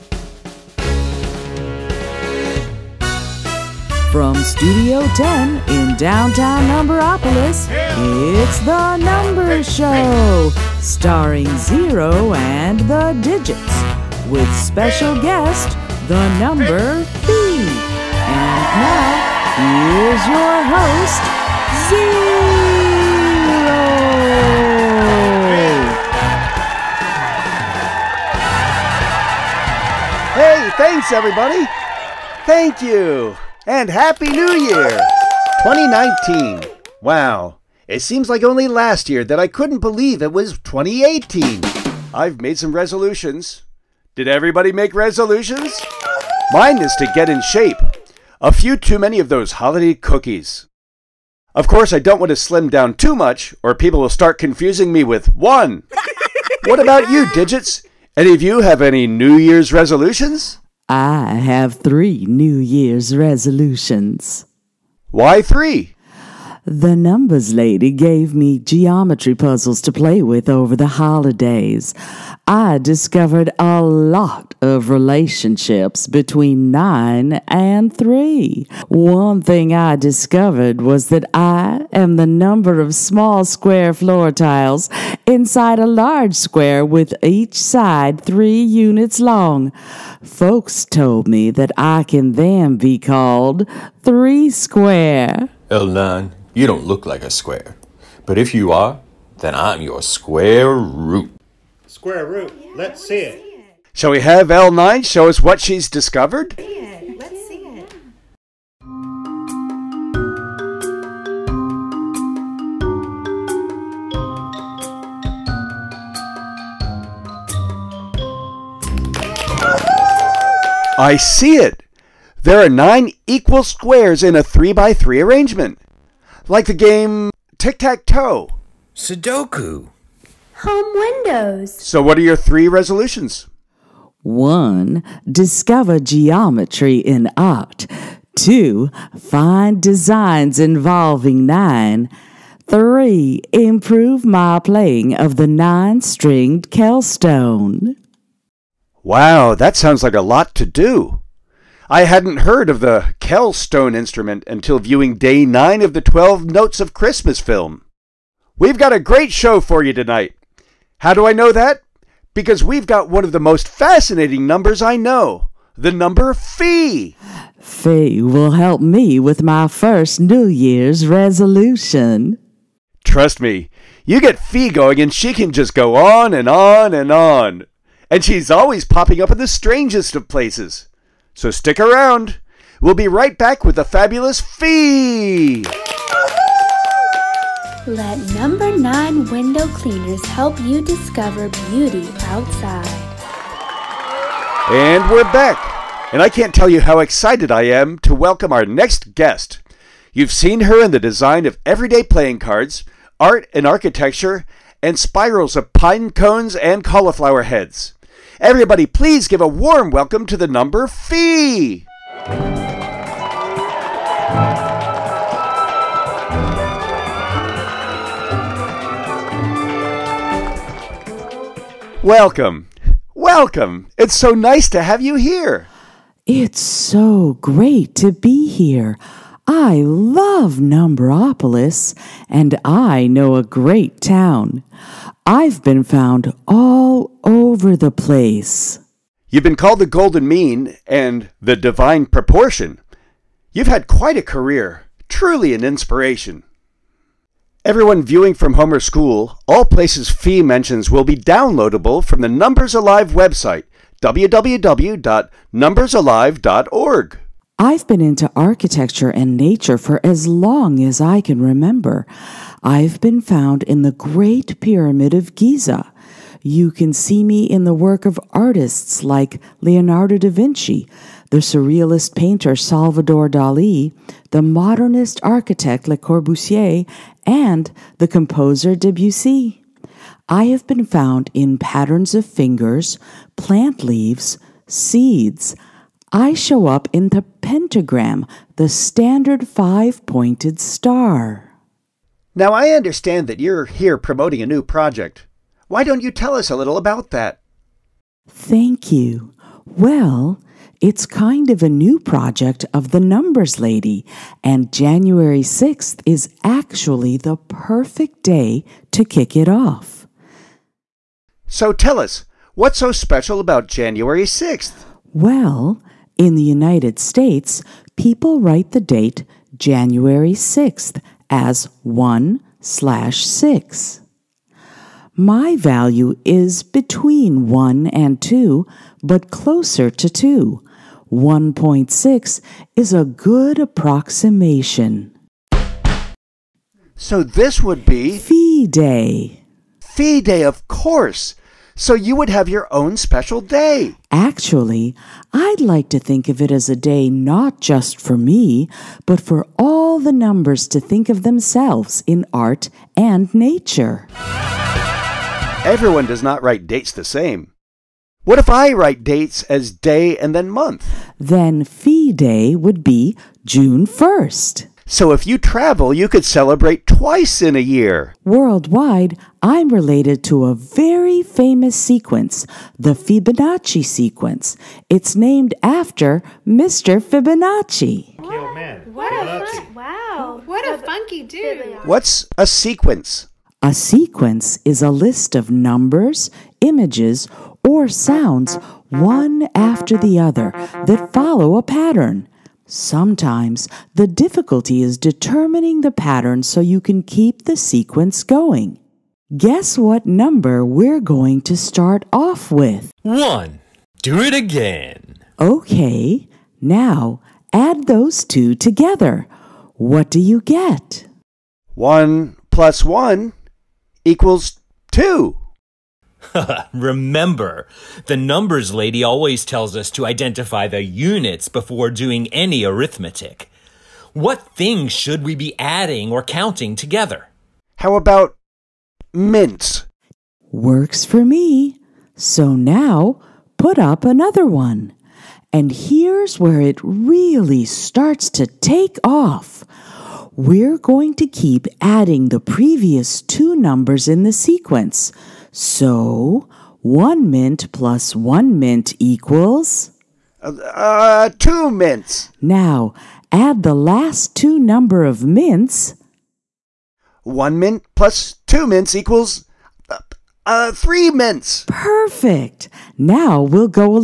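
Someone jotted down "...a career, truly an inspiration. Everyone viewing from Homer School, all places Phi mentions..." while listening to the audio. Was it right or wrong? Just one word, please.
right.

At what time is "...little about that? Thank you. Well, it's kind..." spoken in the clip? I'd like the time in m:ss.
4:56.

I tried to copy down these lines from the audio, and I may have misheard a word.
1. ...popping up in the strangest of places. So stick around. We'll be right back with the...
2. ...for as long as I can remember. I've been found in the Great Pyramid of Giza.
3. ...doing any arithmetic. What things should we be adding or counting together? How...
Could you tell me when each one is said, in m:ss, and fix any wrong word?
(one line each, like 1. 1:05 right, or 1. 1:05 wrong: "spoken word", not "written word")
1. 2:58 right
2. 4:19 right
3. 7:01 right.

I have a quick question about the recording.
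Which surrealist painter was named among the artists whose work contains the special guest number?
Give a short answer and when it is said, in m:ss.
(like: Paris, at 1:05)
Salvador Dali, at 4:32.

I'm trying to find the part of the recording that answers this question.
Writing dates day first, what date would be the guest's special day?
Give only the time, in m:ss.
6:03.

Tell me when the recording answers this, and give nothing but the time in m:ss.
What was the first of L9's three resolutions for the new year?
2:15.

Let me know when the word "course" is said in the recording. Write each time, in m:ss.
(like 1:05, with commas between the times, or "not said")
0:51, 5:40.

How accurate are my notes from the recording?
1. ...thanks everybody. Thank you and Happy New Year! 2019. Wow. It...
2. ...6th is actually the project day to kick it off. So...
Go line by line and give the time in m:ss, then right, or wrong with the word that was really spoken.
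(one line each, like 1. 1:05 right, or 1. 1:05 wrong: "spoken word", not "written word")
1. 0:30 right
2. 5:05 wrong: "perfect", not "project".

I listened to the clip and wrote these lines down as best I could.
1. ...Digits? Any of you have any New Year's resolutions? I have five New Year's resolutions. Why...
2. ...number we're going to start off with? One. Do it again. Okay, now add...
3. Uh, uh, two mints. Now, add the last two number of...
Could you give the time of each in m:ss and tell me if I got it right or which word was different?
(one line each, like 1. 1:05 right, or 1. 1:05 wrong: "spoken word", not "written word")
1. 0:57 wrong: "three", not "five"
2. 6:40 right
3. 7:30 right.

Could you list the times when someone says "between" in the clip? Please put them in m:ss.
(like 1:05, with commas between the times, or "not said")
1:16, 5:26.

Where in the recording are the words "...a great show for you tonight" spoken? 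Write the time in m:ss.
2:38.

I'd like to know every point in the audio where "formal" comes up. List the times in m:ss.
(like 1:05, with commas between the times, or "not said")
not said.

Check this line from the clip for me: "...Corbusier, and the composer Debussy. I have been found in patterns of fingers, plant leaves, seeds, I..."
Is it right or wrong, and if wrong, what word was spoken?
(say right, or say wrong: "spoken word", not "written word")
right.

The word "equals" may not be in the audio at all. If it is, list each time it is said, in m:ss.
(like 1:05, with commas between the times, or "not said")
2:03, 6:54, 7:28, 7:38.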